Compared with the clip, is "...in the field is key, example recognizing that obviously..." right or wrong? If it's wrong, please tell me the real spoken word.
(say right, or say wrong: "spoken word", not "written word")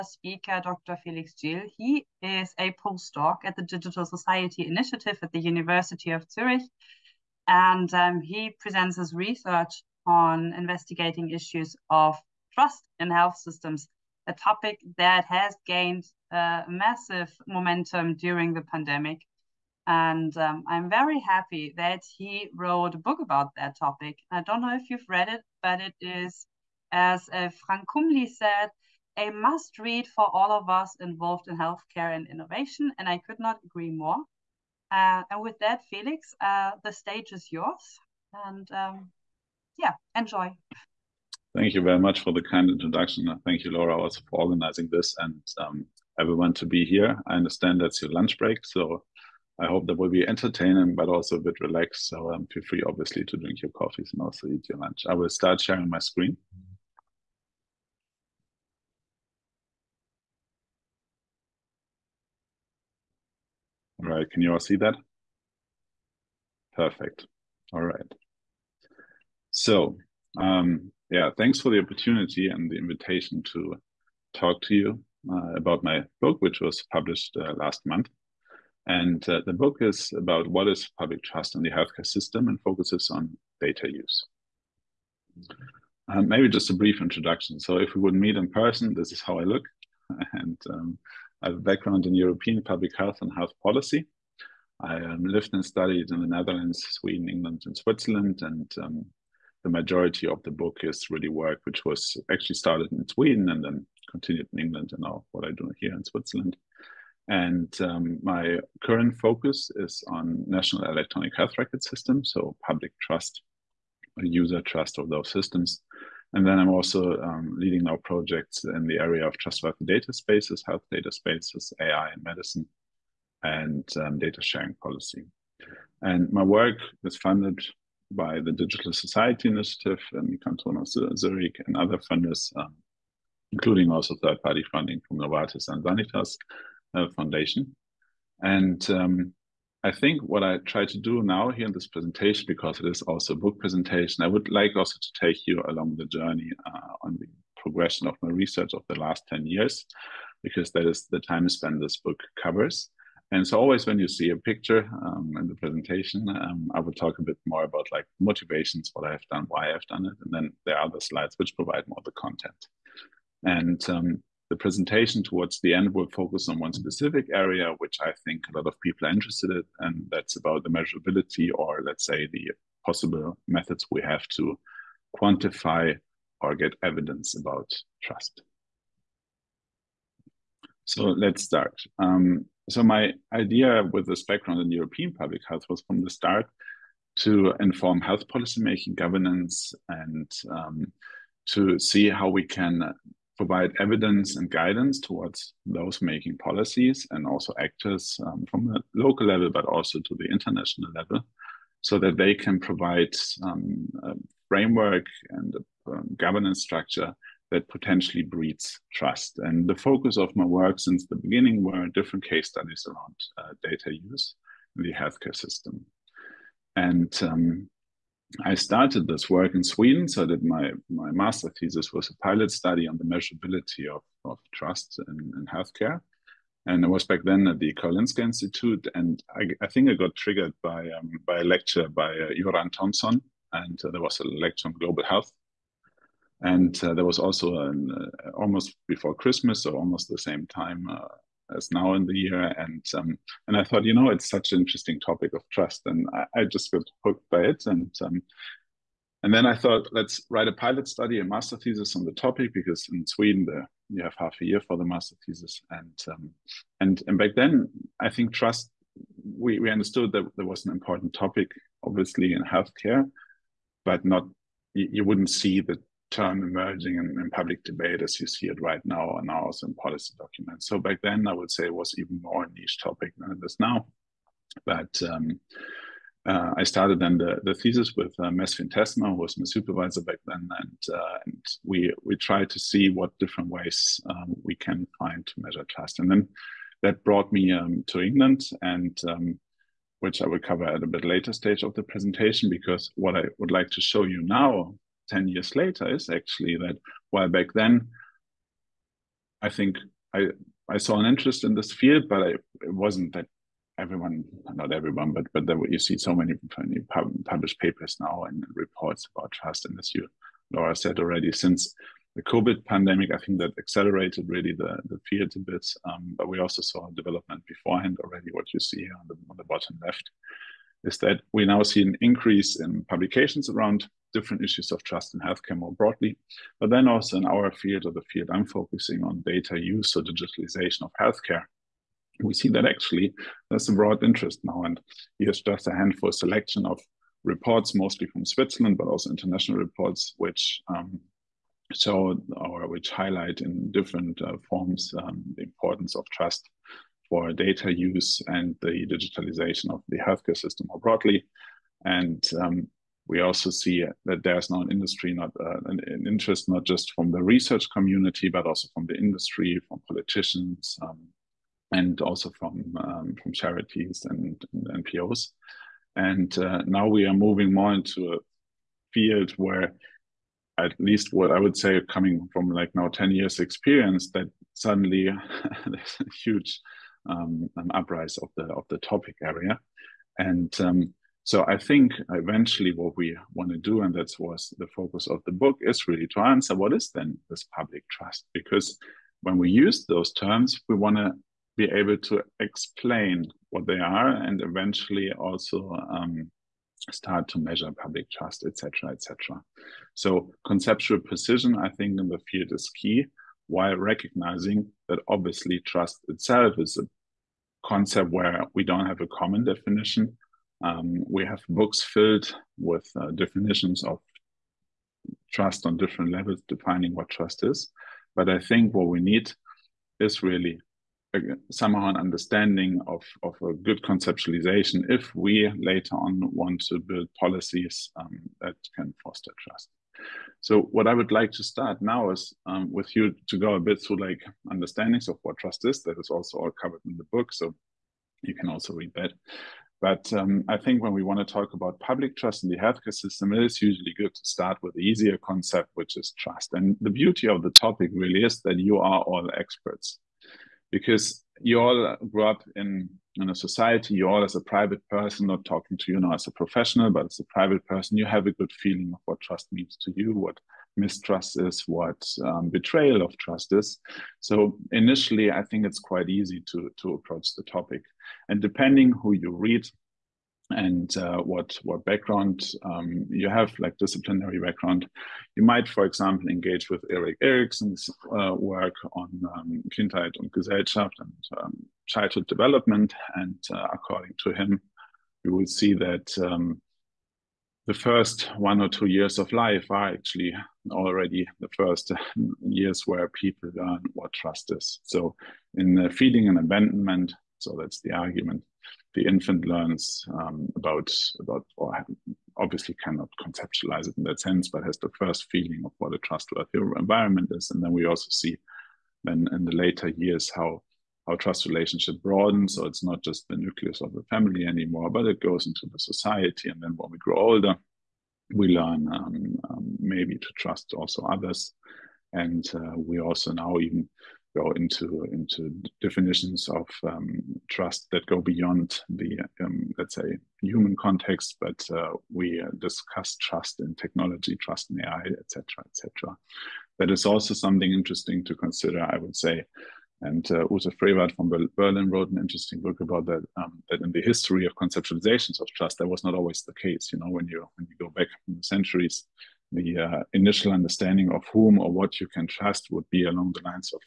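wrong: "while", not "example".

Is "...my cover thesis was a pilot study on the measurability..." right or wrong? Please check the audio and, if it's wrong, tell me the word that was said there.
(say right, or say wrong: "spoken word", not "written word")
wrong: "master", not "cover".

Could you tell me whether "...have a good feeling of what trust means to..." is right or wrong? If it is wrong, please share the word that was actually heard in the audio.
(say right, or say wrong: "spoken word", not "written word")
right.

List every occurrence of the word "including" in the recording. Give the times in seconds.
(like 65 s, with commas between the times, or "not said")
133 s.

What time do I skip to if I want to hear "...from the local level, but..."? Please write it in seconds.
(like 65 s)
198 s.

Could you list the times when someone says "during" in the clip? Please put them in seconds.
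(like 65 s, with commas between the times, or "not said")
18 s.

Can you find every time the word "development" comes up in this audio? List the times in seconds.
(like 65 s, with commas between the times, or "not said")
316 s, 482 s.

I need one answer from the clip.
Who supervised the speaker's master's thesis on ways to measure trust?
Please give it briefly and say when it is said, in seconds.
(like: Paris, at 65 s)
Mesfin Tessma, at 278 s.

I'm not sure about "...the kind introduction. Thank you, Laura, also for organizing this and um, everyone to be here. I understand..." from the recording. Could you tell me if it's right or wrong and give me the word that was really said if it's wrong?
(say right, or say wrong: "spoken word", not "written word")
right.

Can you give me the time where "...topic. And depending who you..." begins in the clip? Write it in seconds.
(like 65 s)
467 s.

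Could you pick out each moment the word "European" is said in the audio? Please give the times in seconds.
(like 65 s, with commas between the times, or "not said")
92 s, 184 s.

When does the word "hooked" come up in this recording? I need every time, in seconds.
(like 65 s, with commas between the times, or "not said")
247 s.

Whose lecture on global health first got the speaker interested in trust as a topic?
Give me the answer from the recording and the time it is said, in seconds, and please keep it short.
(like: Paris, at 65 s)
Göran Tomson, at 232 s.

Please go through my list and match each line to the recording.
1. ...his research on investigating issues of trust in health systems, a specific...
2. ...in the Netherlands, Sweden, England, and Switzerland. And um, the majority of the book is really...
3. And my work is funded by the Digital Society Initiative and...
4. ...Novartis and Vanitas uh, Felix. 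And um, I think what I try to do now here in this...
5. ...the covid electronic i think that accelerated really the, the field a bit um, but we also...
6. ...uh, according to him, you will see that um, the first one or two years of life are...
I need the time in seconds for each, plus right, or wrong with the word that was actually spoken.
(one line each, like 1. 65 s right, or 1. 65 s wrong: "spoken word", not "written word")
1. 8 s wrong: "topic", not "specific"
2. 96 s right
3. 125 s right
4. 135 s wrong: "Foundation", not "Felix"
5. 312 s wrong: "pandemic", not "electronic"
6. 483 s right.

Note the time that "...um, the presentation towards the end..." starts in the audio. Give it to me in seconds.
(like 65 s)
163 s.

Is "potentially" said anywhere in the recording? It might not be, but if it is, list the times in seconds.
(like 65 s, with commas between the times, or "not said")
207 s.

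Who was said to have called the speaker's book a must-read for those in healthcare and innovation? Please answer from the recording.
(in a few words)
Frank Kumli.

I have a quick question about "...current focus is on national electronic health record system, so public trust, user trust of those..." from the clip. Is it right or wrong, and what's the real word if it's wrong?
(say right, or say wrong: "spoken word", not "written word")
right.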